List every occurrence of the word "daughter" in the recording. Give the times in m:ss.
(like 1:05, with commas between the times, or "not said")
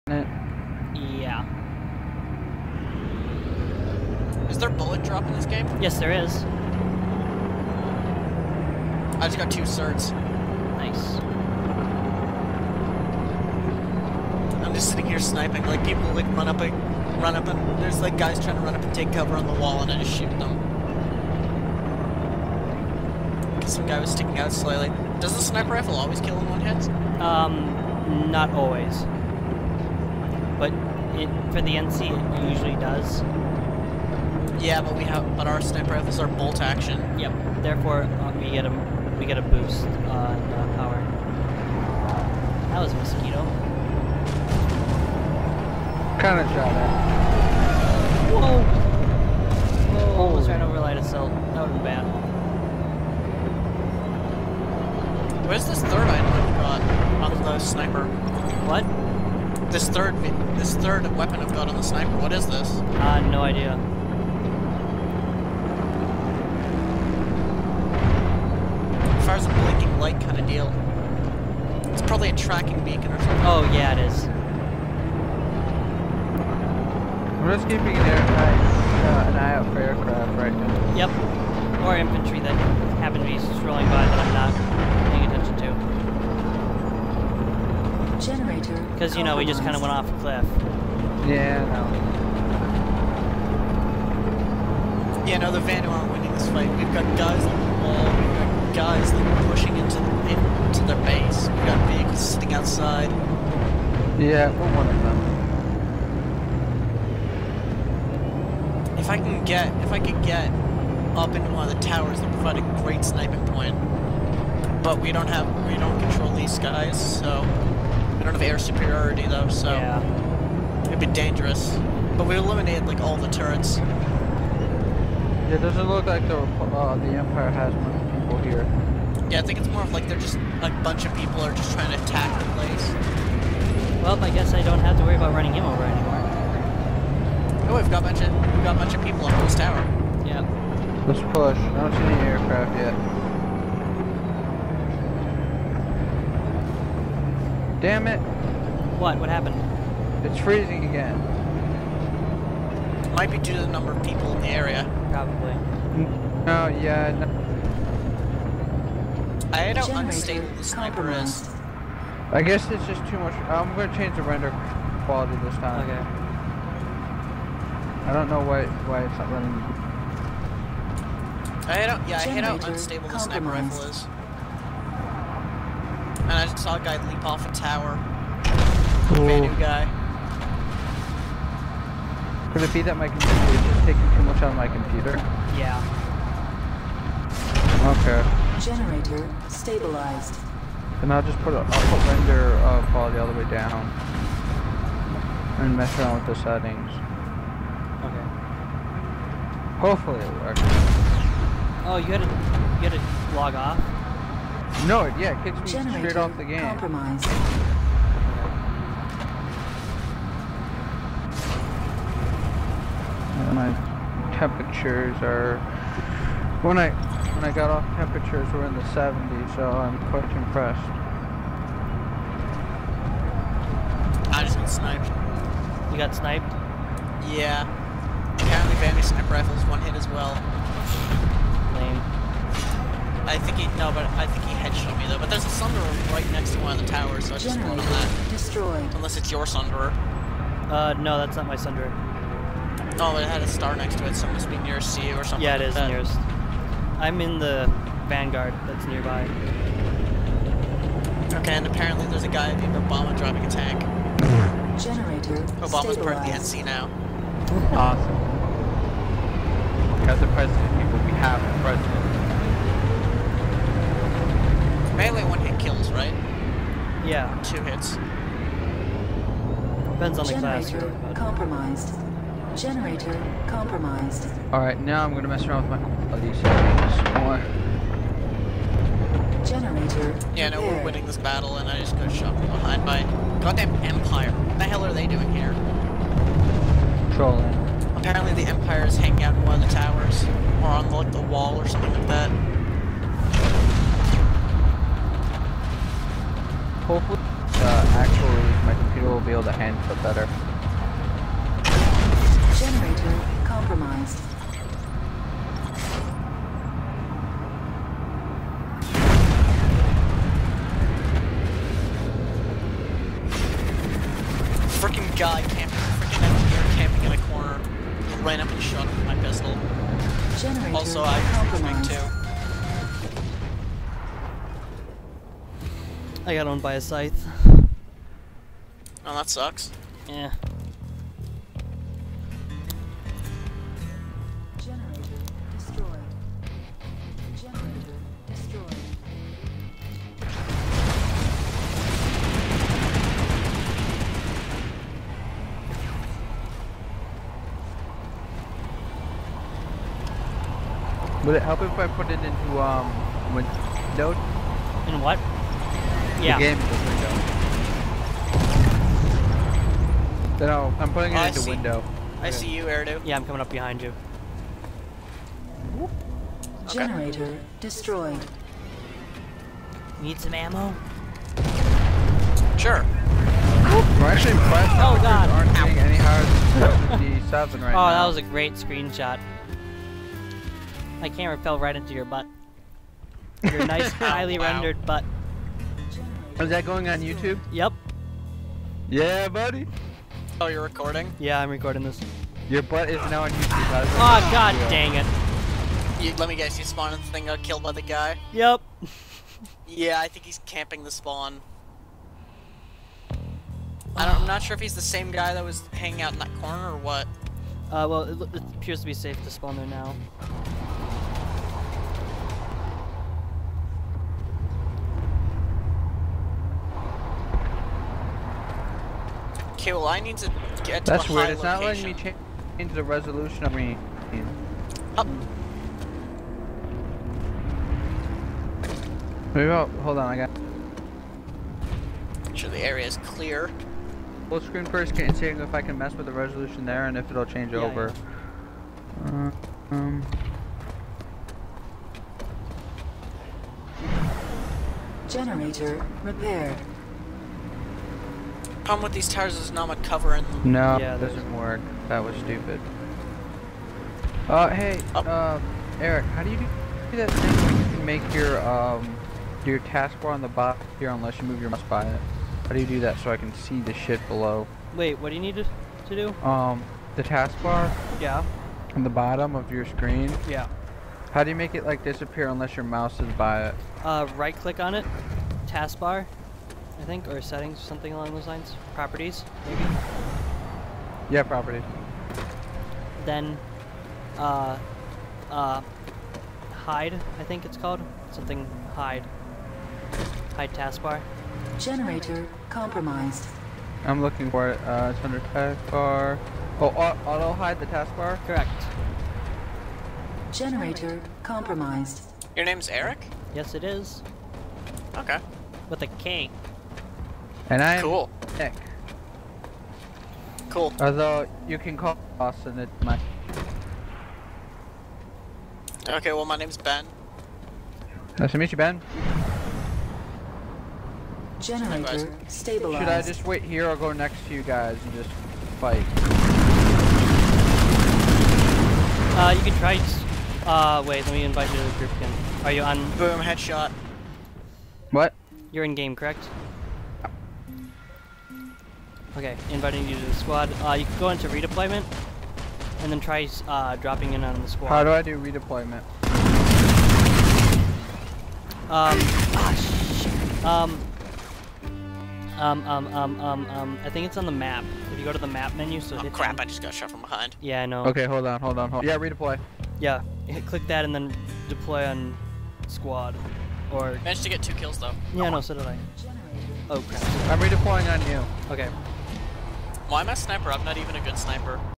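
not said.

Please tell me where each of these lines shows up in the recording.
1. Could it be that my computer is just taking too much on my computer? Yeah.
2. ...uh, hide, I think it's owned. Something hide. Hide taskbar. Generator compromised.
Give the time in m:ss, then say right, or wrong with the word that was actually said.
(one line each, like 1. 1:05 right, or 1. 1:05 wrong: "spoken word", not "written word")
1. 3:02 right
2. 8:05 wrong: "called", not "owned".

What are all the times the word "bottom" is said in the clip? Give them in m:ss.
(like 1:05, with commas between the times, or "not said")
7:40, 7:48.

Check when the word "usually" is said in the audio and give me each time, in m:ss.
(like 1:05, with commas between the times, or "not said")
0:32.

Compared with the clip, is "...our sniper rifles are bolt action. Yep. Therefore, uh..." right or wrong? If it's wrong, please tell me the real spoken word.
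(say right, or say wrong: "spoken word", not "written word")
right.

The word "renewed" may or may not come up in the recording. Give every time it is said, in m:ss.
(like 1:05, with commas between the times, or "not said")
not said.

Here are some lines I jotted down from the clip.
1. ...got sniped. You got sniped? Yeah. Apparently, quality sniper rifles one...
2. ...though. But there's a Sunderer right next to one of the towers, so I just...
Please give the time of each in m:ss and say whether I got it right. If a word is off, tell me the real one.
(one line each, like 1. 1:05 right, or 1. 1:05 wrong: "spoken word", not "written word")
1. 3:44 wrong: "vanity", not "quality"
2. 3:55 right.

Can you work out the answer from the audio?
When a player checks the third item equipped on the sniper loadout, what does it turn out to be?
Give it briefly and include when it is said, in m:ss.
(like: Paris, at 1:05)
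Tracking beacon, at 1:12.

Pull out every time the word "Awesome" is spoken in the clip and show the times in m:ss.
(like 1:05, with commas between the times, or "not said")
4:17.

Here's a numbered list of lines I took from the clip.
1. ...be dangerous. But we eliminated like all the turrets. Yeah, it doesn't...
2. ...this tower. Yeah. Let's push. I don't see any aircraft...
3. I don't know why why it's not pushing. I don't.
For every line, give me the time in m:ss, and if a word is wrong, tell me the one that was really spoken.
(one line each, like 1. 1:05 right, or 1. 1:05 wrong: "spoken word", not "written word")
1. 2:00 right
2. 2:19 right
3. 2:48 wrong: "running", not "pushing".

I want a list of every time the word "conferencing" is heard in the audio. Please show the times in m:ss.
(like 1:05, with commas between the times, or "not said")
not said.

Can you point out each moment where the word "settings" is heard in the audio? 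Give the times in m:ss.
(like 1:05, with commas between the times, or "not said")
3:16, 7:57.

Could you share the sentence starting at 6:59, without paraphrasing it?
Okay, well I need to get to That's weird, it's not location.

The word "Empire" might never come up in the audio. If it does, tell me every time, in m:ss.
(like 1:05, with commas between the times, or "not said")
2:07, 4:43, 4:48.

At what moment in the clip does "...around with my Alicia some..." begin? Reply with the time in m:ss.
4:35.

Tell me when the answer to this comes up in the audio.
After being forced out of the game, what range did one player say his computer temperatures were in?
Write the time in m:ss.
3:38.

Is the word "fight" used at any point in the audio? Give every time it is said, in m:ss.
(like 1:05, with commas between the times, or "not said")
1:36, 8:45.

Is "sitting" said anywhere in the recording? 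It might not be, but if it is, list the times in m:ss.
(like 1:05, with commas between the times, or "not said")
0:14, 1:42.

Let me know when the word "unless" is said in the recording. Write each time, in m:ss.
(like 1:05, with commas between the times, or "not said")
3:58, 7:40, 7:52.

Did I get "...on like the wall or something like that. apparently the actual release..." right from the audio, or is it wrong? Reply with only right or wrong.
wrong.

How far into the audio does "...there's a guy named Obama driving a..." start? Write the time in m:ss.
4:12.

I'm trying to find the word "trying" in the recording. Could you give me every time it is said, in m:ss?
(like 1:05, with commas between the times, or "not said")
0:18, 2:11.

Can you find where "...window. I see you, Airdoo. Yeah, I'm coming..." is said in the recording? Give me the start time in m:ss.
6:01.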